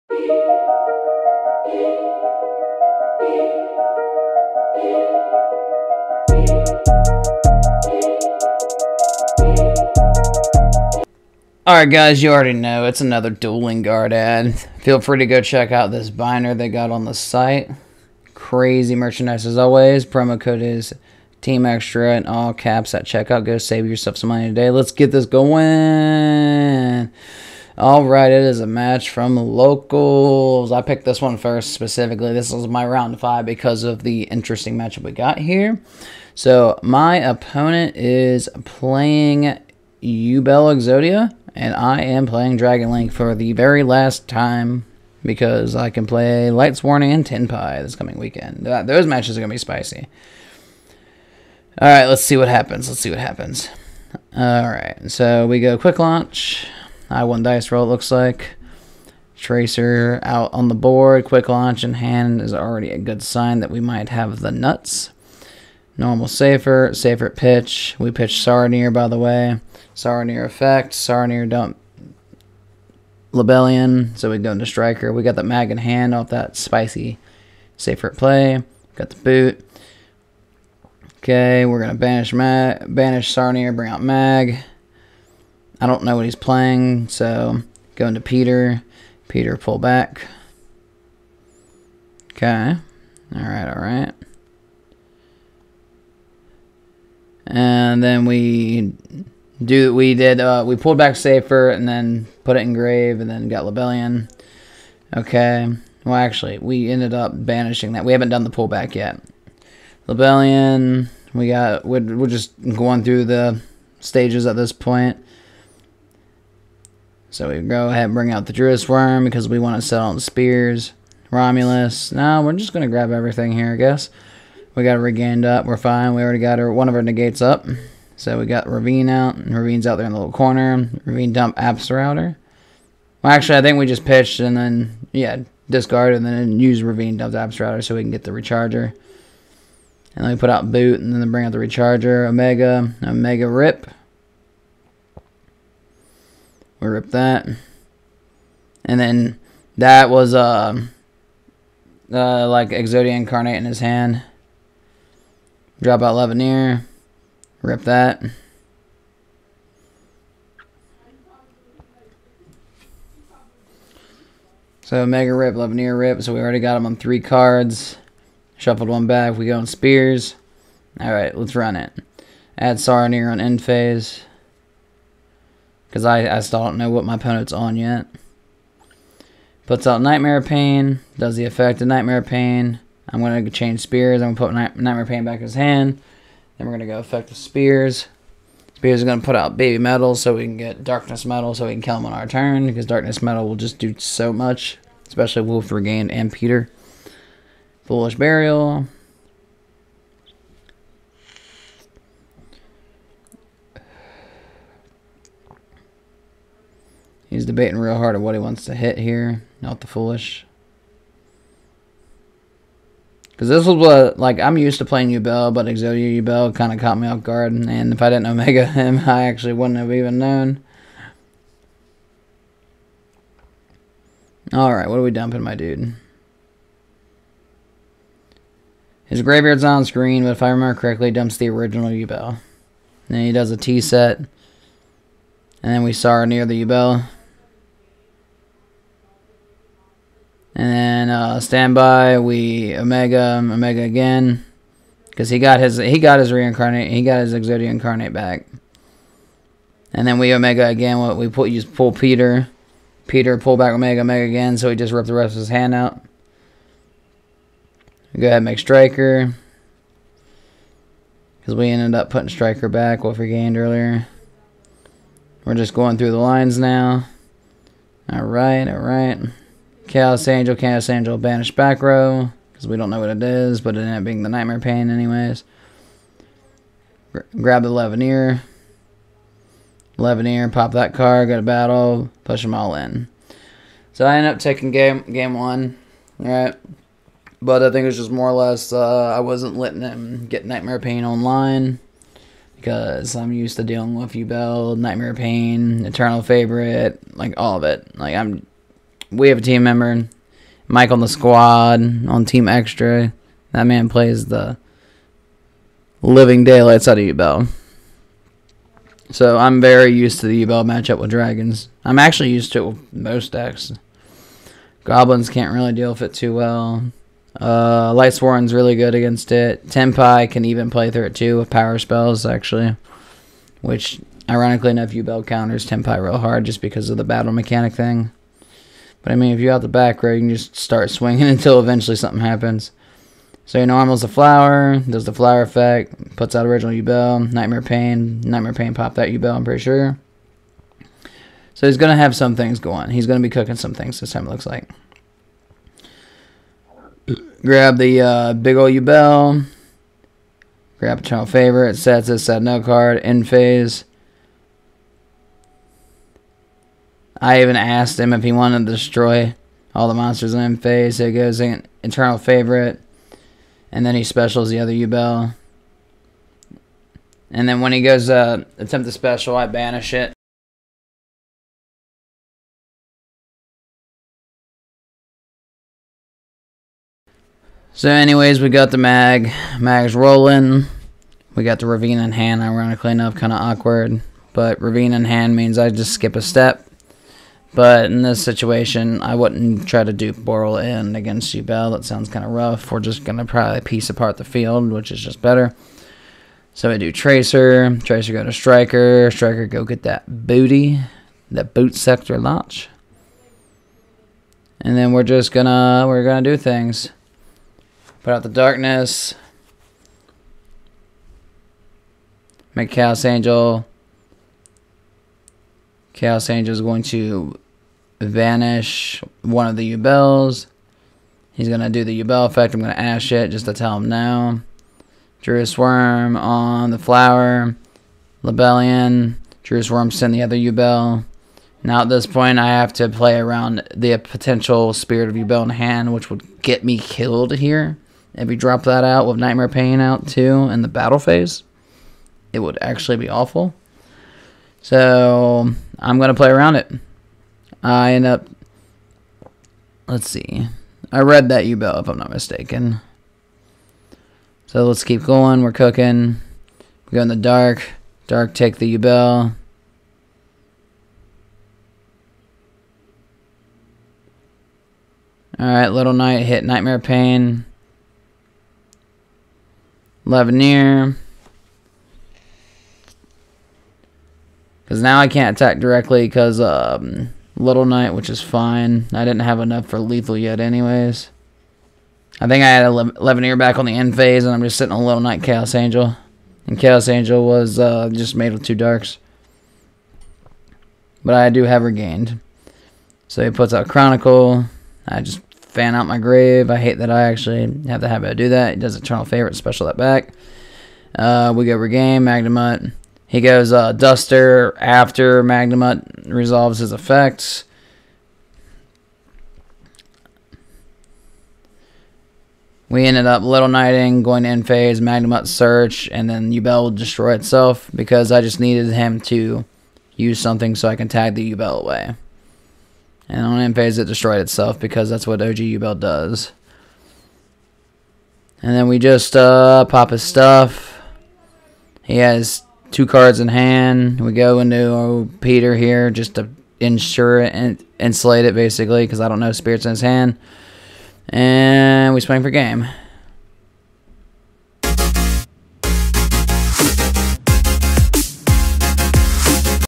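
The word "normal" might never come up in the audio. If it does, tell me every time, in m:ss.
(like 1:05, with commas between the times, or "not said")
1:05, 5:33.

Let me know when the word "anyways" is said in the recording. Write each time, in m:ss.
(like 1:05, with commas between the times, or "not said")
4:34, 6:17, 8:00.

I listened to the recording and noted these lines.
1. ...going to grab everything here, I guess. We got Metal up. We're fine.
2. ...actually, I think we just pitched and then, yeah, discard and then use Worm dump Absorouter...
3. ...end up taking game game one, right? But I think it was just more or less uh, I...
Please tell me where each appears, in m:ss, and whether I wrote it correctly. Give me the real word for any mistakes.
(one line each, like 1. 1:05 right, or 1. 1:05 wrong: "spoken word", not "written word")
1. 2:02 wrong: "Regained", not "Metal"
2. 2:13 wrong: "Ravine", not "Worm"
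3. 4:44 right.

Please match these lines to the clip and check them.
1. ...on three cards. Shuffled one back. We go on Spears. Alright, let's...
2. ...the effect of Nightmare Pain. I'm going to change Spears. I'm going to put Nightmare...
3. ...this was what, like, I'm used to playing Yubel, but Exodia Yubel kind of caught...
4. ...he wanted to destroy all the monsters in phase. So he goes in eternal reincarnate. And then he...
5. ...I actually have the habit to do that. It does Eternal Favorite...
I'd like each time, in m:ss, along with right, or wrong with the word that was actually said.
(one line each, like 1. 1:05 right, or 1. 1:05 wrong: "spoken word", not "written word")
1. 2:46 right
2. 3:01 right
3. 3:33 right
4. 5:58 wrong: "favorite", not "reincarnate"
5. 8:16 right.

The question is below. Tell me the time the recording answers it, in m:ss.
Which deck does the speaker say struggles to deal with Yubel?
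5:14.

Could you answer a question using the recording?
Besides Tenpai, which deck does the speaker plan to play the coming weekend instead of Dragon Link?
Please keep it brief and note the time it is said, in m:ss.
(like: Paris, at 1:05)
Lightsworn, at 0:45.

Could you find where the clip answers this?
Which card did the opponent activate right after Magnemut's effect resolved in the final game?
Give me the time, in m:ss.
8:23.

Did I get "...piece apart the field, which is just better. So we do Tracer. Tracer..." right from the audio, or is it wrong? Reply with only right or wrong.
right.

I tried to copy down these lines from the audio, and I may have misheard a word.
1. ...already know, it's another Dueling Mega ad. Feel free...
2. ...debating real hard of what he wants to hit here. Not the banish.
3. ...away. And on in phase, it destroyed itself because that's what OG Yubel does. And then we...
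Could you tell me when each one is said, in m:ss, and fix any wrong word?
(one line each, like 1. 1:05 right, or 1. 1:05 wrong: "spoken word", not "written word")
1. 0:12 wrong: "Guard", not "Mega"
2. 3:27 wrong: "foolish", not "banish"
3. 8:41 right.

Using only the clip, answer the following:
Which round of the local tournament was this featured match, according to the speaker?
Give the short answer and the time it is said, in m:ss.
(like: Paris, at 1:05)
round five, at 0:32.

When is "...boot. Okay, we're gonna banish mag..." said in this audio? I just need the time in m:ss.
1:19.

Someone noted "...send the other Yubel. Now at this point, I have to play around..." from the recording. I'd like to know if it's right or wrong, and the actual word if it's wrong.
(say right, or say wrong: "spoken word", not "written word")
right.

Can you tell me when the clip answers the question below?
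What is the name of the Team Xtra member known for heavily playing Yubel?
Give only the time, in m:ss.
5:00.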